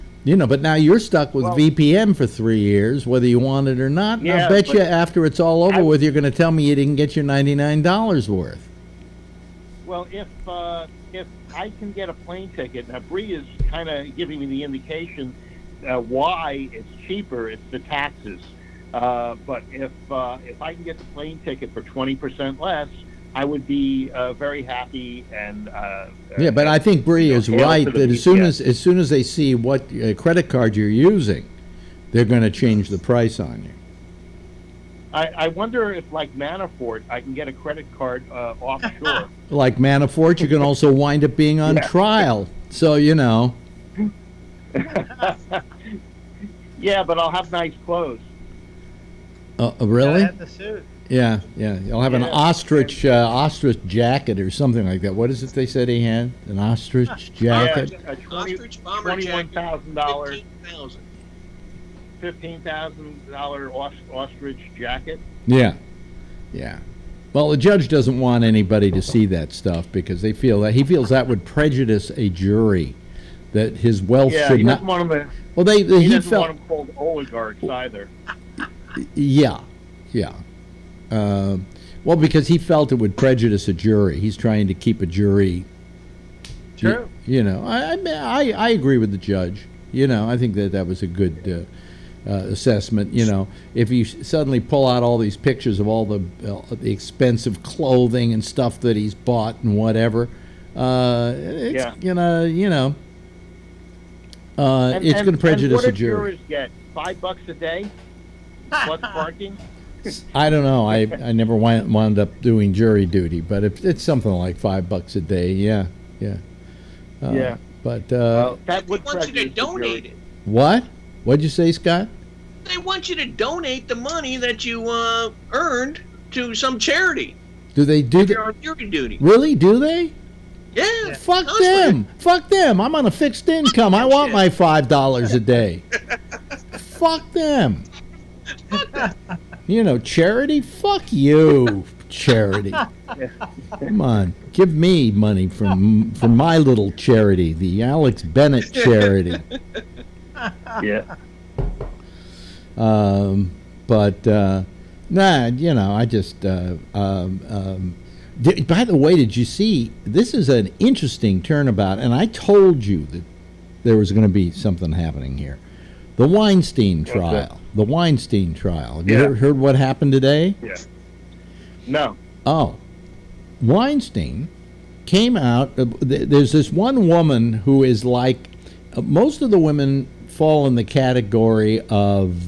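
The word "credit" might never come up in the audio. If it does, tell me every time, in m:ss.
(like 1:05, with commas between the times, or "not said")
0:30, 0:37.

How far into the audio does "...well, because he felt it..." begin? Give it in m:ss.
1:22.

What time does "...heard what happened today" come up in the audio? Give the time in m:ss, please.
2:49.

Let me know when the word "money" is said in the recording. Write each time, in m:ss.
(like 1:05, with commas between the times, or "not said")
2:03, 2:25.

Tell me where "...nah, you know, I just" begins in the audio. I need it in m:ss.
2:35.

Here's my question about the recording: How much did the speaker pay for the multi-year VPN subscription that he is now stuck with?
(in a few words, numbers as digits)
$99.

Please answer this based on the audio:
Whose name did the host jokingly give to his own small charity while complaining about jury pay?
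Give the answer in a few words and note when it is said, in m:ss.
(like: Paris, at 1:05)
Alex Bennett, at 2:27.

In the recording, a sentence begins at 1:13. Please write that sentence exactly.
That his wealth Yeah, should he not.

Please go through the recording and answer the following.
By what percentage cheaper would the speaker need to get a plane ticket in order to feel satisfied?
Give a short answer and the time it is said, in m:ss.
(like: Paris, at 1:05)
20%, at 0:21.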